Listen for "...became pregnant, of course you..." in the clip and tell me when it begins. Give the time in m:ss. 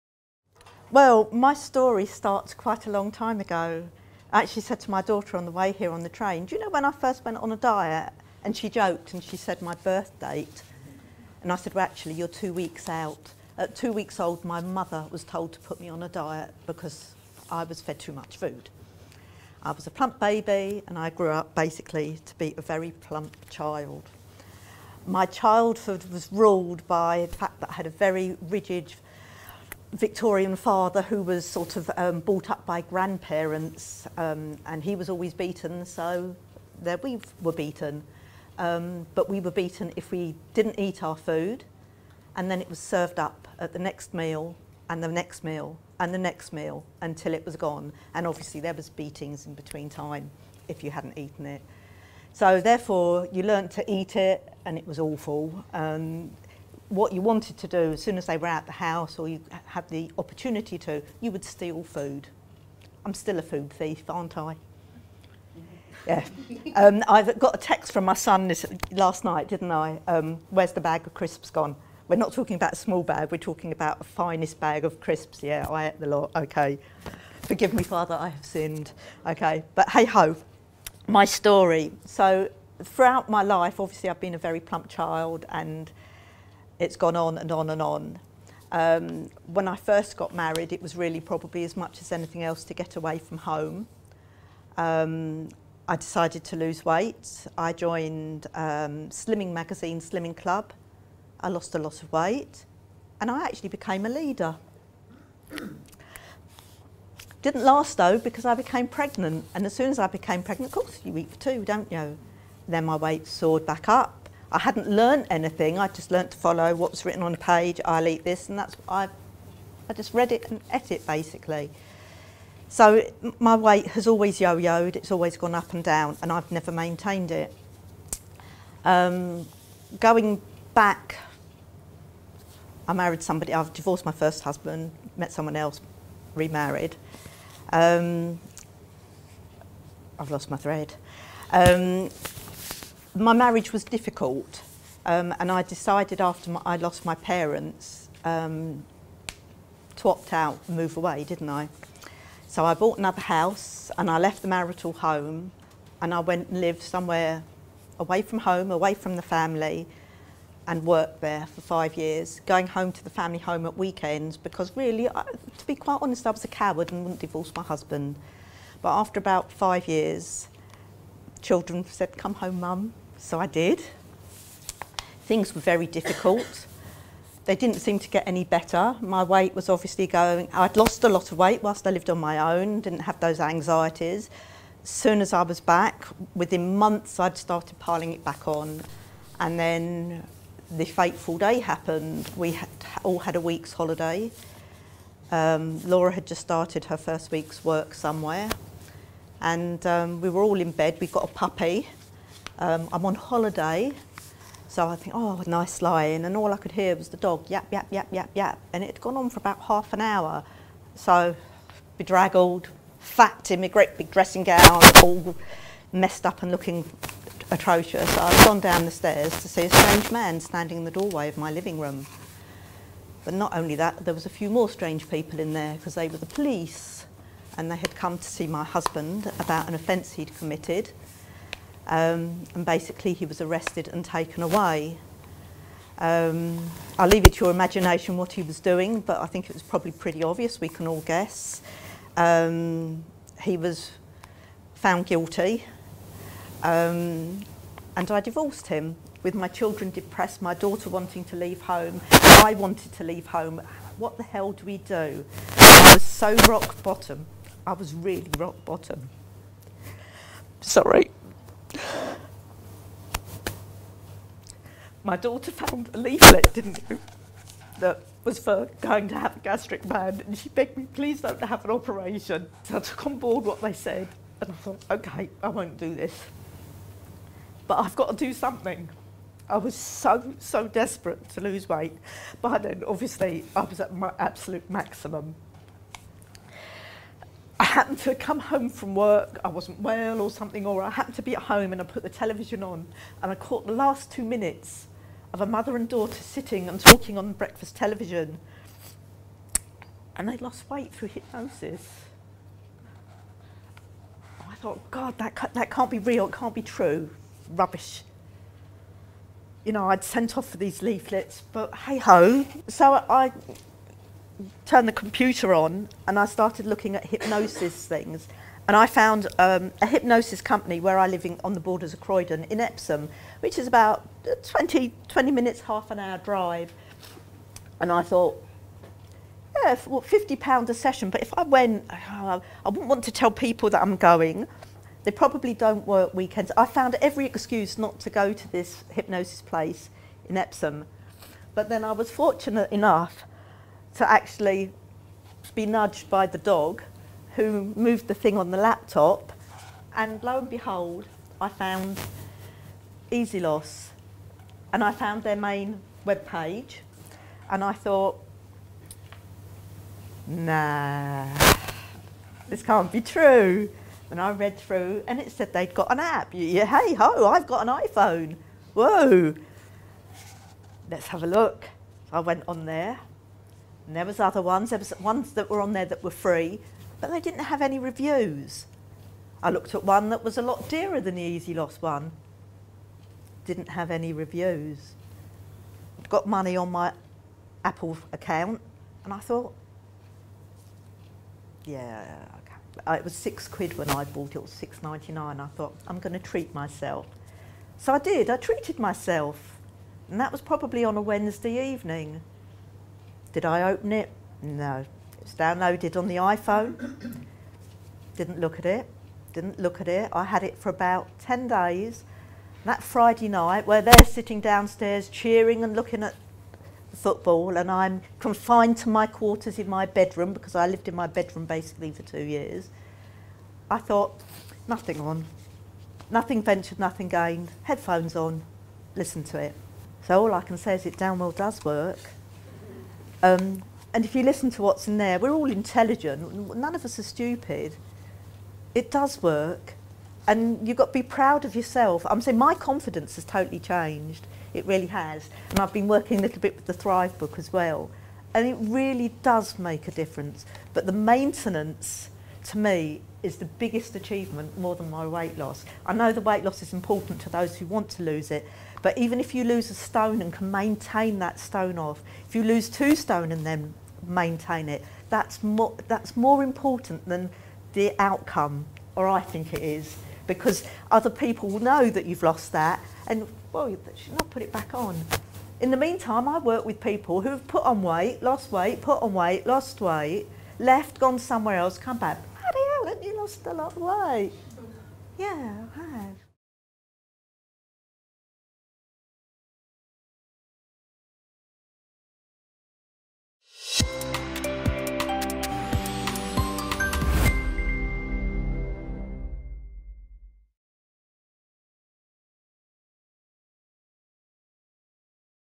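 1:50.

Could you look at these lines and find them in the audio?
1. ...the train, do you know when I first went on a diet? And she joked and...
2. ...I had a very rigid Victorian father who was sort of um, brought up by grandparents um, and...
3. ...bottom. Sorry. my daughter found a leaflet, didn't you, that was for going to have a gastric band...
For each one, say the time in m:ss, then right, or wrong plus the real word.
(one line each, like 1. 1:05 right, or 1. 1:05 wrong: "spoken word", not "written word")
1. 0:06 right
2. 0:27 right
3. 4:18 right.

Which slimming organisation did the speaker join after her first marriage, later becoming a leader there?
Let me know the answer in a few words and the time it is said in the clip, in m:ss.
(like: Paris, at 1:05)
Slimming Magazine, Slimming Club, at 1:39.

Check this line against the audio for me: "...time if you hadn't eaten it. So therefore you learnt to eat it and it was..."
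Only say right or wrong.
right.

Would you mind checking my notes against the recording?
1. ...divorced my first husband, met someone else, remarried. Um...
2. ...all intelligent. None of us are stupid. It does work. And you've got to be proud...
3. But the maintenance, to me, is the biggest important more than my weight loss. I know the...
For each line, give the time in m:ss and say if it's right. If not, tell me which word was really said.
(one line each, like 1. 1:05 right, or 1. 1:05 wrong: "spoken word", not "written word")
1. 2:13 right
2. 7:15 right
3. 7:30 wrong: "achievement", not "important".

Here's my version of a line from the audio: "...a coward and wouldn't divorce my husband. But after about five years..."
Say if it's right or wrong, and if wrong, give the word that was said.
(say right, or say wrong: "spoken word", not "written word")
right.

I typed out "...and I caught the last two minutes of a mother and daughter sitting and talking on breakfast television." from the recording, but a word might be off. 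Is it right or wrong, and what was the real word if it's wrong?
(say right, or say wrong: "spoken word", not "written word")
right.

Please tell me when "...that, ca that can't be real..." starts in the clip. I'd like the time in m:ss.
5:05.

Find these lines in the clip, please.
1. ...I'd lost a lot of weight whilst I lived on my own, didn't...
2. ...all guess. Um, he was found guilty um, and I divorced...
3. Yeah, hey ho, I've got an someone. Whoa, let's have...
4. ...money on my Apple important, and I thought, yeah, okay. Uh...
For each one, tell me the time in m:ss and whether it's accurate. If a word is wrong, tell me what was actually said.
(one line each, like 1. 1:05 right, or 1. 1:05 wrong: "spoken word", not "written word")
1. 3:00 right
2. 4:00 right
3. 6:06 wrong: "iPhone", not "someone"
4. 6:26 wrong: "account", not "important".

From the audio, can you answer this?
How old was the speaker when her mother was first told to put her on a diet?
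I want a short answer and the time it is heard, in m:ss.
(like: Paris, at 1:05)
2 weeks old, at 0:13.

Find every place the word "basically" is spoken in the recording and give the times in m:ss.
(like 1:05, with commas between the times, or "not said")
0:21, 2:01, 3:52, 7:01.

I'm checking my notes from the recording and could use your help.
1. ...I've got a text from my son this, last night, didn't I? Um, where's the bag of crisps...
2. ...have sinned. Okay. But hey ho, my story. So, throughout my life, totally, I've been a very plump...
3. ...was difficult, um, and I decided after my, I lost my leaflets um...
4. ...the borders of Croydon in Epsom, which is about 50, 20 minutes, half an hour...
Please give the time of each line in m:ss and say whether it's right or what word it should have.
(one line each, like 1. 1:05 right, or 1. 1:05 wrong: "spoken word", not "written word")
1. 1:07 right
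2. 1:18 wrong: "obviously", not "totally"
3. 2:23 wrong: "parents", not "leaflets"
4. 5:21 wrong: "20", not "50".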